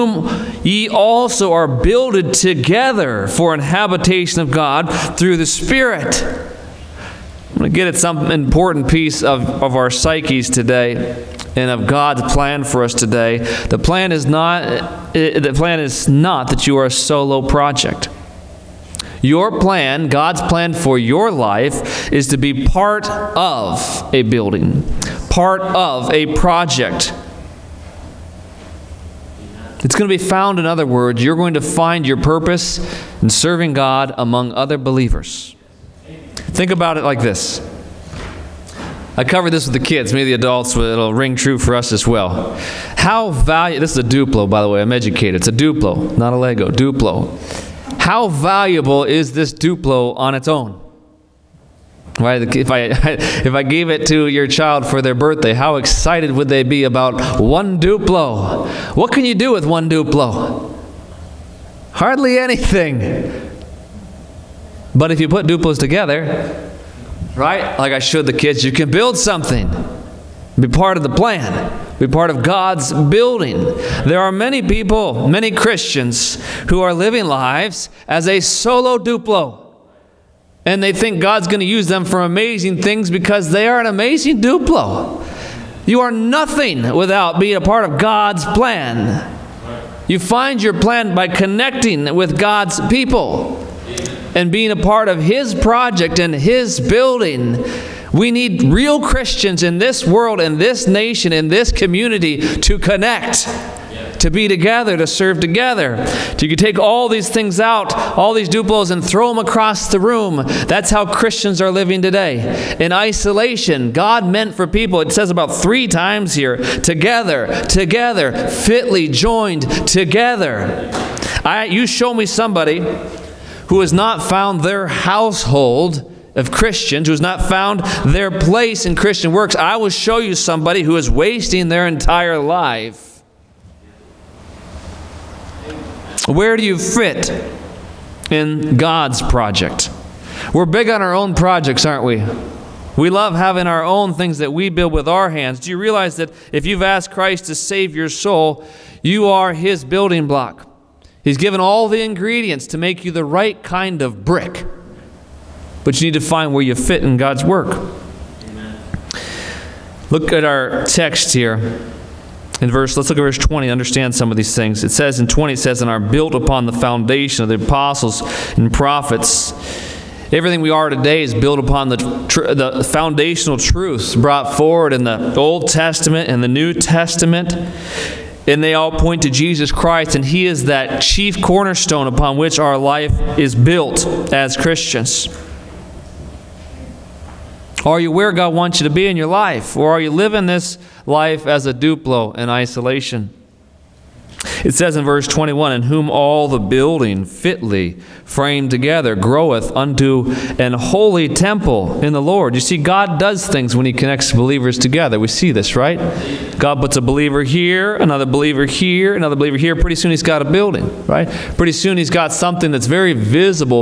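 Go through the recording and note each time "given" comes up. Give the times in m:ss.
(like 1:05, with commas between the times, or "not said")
2:31.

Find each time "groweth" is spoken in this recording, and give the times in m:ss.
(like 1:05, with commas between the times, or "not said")
3:19.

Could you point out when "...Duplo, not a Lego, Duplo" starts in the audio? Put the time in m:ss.
0:45.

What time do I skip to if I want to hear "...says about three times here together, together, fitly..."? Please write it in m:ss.
1:55.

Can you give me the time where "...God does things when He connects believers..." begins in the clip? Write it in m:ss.
3:22.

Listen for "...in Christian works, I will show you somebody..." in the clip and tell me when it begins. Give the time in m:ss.
2:08.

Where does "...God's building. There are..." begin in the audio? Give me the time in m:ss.
1:12.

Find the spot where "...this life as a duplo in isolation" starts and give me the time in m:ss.
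3:10.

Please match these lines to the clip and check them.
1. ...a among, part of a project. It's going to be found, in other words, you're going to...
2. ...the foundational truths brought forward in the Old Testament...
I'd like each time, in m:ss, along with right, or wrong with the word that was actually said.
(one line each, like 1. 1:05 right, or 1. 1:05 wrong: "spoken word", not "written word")
1. 0:24 wrong: "building", not "among"
2. 2:52 right.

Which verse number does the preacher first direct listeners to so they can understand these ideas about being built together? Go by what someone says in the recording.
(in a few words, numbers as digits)
20.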